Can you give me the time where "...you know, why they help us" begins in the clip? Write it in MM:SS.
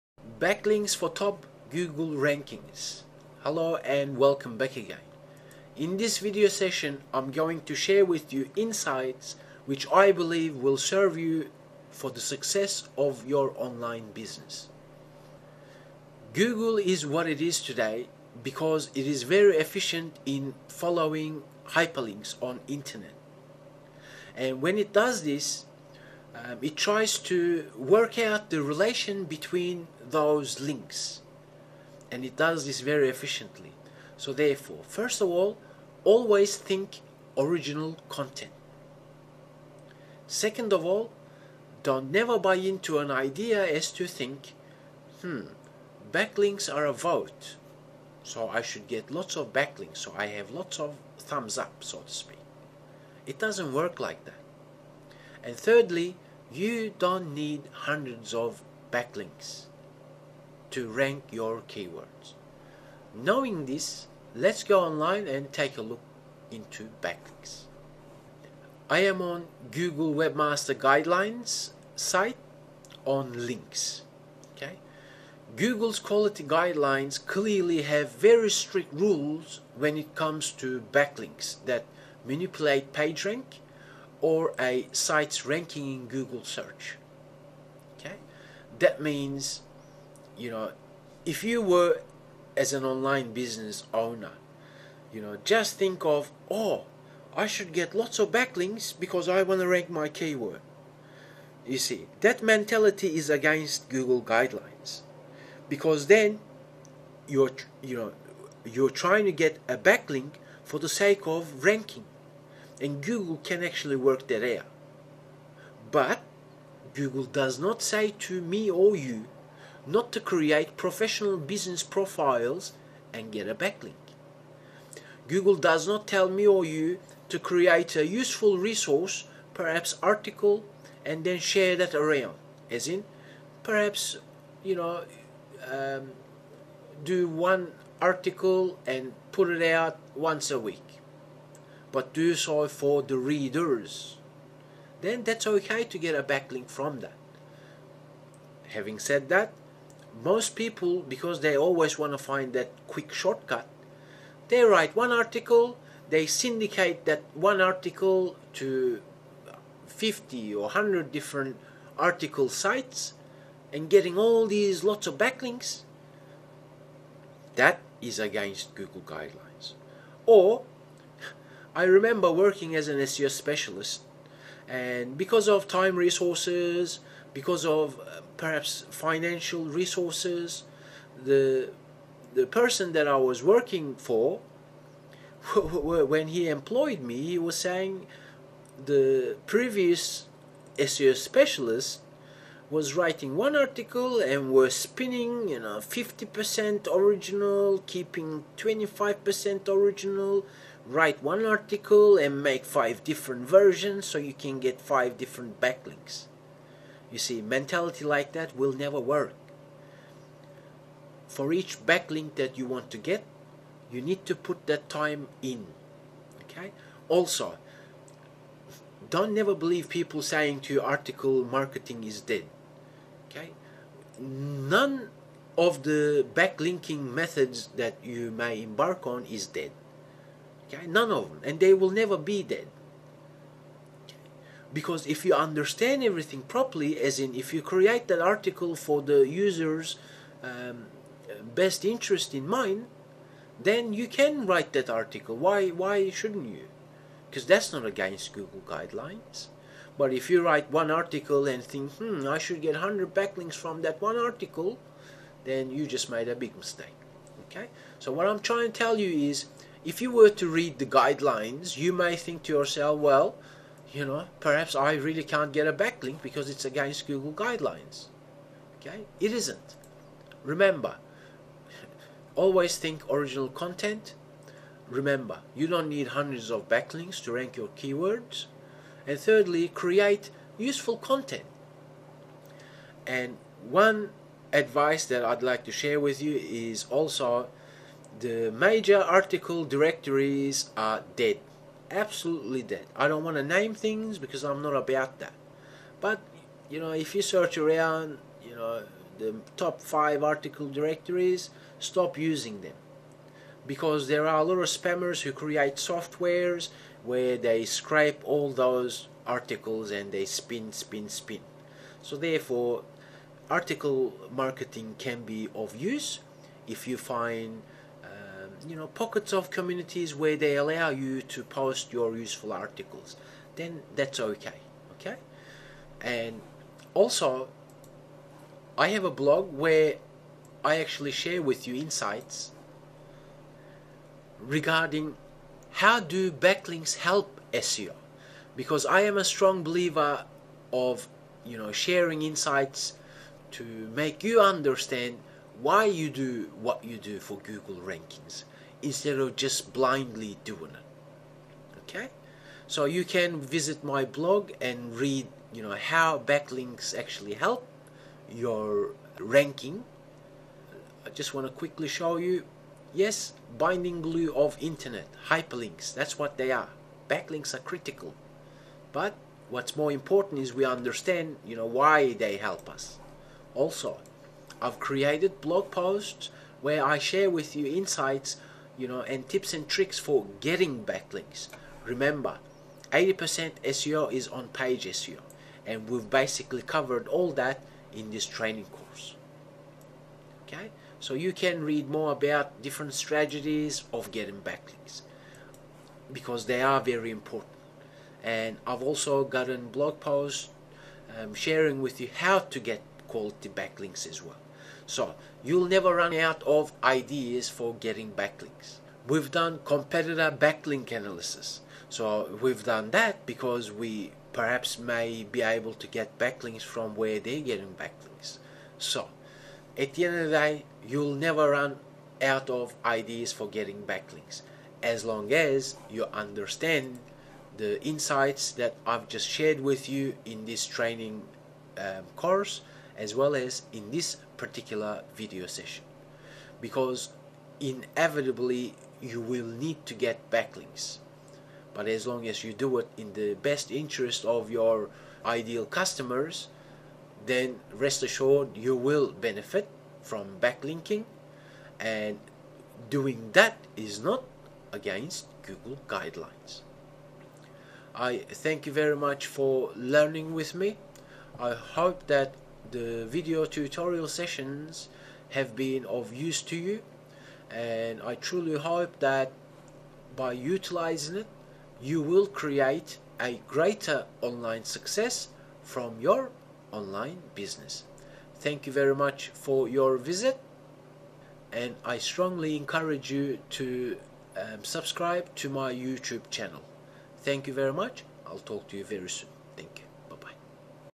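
06:11.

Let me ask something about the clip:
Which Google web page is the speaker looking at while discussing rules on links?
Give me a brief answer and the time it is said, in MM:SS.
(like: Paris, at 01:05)
Google Webmaster Guidelines, at 01:09.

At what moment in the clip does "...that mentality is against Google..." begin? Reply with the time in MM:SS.
01:42.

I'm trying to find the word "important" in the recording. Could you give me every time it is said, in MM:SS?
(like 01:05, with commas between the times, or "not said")
06:09, 06:37.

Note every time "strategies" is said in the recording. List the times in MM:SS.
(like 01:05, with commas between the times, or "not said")
06:32.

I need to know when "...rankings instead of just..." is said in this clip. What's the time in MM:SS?
05:47.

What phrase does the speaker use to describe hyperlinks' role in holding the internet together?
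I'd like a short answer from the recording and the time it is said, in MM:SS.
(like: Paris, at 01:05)
binding glue, at 06:03.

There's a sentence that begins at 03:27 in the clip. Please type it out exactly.
You see, mentality like that will never work.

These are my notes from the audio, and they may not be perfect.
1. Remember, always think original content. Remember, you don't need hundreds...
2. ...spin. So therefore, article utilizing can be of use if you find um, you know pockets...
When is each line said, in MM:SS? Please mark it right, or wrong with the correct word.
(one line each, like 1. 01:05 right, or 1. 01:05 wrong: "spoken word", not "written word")
1. 04:30 right
2. 05:11 wrong: "marketing", not "utilizing".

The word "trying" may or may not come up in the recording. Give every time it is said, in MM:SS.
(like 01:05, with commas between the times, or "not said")
01:48, 04:18.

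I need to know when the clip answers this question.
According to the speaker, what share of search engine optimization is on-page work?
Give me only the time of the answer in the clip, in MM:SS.
06:22.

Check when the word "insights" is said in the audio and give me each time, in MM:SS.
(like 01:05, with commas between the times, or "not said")
00:08, 05:31, 05:42, 06:17, 07:07.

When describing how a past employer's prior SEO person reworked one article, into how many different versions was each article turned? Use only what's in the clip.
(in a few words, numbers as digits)
5.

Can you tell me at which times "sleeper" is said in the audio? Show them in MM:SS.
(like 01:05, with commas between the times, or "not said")
not said.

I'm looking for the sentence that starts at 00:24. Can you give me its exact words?
And when it does this, um, it tries to work out the relation between those links and it does this very efficiently.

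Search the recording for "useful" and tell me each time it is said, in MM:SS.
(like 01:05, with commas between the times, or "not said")
02:08, 04:40, 05:22.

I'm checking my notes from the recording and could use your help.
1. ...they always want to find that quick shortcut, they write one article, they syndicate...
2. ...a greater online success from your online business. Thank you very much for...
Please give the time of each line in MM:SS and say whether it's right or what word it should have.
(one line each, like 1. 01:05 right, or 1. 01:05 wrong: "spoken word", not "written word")
1. 02:31 right
2. 07:53 right.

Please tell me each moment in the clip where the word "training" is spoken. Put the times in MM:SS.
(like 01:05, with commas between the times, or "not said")
06:28, 07:10.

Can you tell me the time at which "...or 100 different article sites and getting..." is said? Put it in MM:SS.
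02:40.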